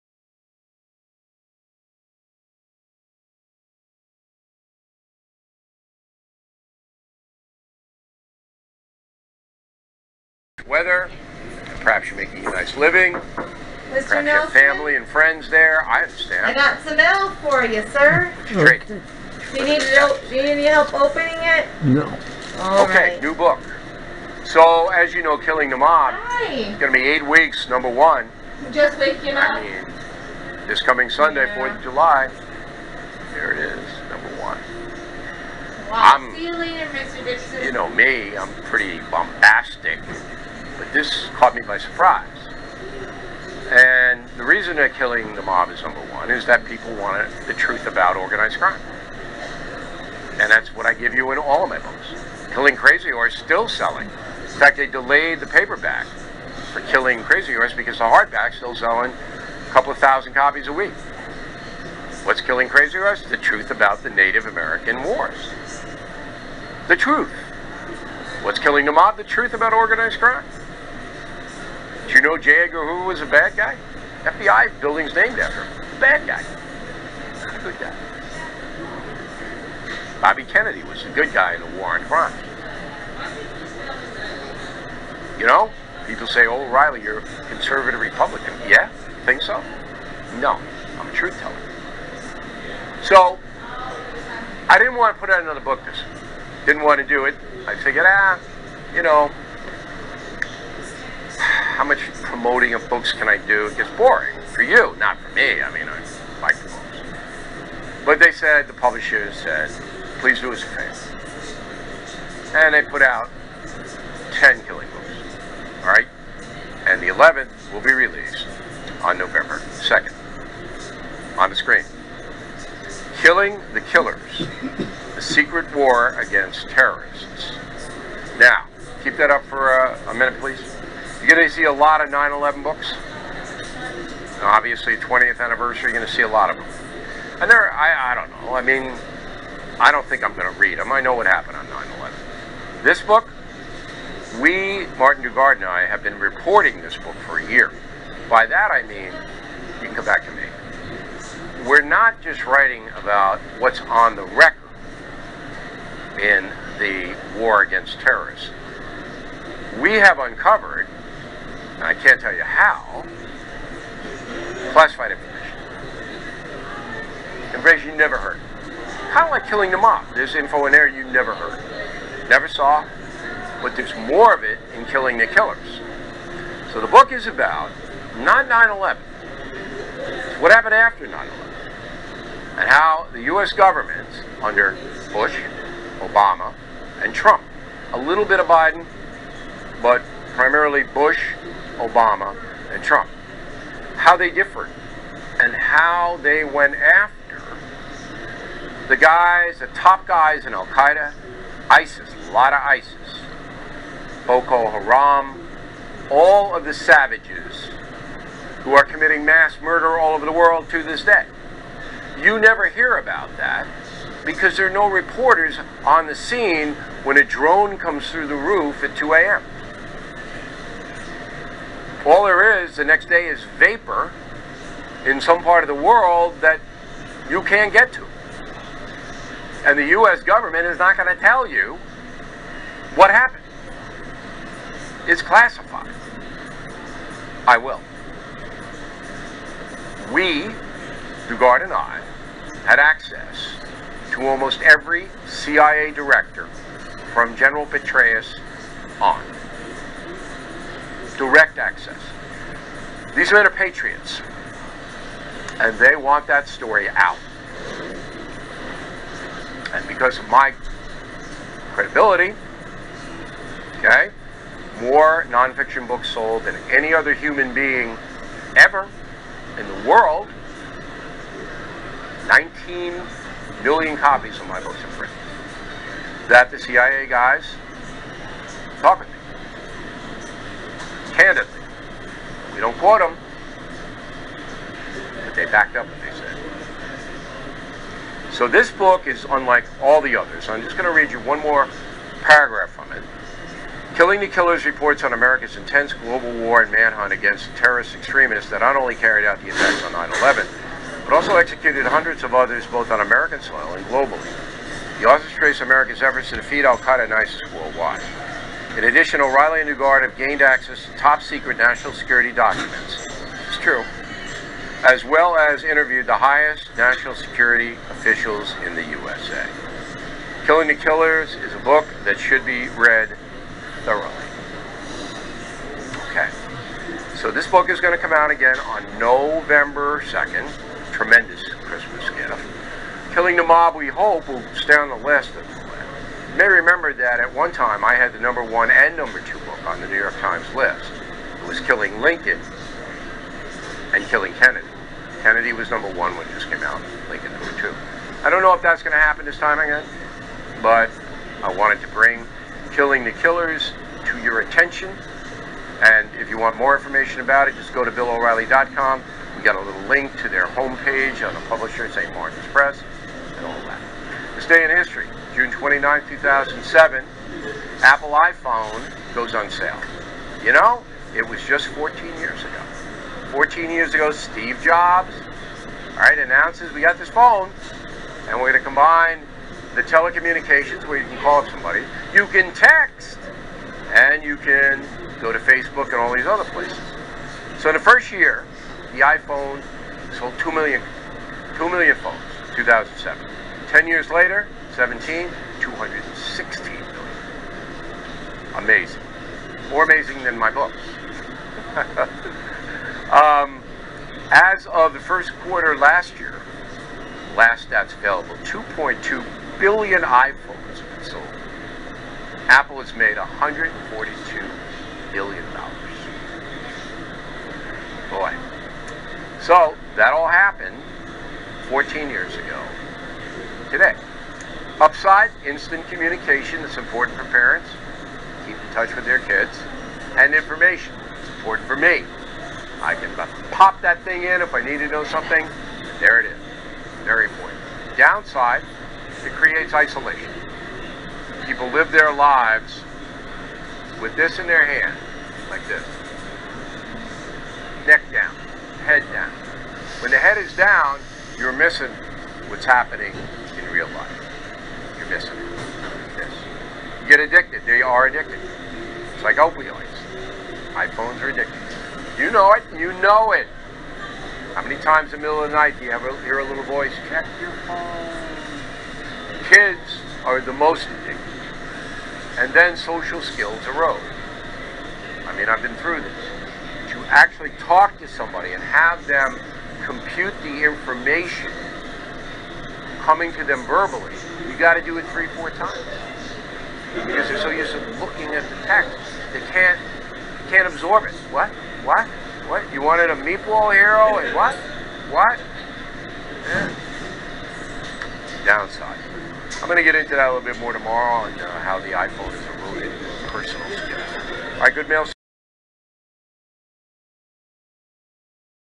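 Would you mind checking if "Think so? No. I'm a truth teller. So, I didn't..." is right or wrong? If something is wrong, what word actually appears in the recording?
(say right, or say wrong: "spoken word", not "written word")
right.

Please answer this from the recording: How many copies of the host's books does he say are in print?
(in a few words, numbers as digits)
19 million.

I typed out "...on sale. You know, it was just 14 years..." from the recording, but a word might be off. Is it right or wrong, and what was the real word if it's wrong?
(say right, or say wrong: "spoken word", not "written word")
right.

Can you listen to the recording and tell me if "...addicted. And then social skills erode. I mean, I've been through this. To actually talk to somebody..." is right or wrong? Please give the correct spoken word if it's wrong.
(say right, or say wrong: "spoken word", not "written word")
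right.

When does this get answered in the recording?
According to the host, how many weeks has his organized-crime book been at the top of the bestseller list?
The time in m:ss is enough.
0:27.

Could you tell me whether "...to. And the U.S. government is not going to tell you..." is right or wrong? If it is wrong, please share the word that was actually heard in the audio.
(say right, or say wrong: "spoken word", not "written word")
right.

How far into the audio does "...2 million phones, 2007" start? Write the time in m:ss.
6:31.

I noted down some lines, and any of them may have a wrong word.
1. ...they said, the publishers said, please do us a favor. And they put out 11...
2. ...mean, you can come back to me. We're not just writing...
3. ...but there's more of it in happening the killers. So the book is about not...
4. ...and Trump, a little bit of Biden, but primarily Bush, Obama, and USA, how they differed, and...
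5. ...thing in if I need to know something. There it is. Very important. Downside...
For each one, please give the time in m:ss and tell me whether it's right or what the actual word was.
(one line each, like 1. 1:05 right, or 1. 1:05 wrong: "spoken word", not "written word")
1. 1:48 wrong: "10", not "11"
2. 2:28 right
3. 2:53 wrong: "killing", not "happening"
4. 3:07 wrong: "Trump", not "USA"
5. 7:14 right.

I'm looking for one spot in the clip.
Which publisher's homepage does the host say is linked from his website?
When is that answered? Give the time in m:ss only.
6:01.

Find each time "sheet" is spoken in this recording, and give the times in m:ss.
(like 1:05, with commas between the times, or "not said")
not said.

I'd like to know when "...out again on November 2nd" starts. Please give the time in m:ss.
5:28.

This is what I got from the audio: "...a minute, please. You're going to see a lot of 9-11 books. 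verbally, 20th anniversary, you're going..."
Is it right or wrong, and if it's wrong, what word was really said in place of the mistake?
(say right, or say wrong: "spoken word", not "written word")
wrong: "obviously", not "verbally".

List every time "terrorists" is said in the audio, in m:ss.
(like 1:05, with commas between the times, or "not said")
2:06, 2:37, 4:57.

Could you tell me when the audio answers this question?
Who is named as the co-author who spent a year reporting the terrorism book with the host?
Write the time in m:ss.
2:24.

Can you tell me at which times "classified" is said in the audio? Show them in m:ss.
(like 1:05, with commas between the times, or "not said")
2:44, 3:55.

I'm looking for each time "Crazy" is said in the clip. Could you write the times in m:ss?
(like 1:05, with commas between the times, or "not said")
0:52, 0:57, 1:02.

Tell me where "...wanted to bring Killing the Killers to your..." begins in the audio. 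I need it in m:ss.
5:51.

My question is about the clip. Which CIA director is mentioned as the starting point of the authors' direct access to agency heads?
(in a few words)
General Petraeus.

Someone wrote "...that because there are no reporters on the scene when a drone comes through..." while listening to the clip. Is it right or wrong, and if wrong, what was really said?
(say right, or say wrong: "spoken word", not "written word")
right.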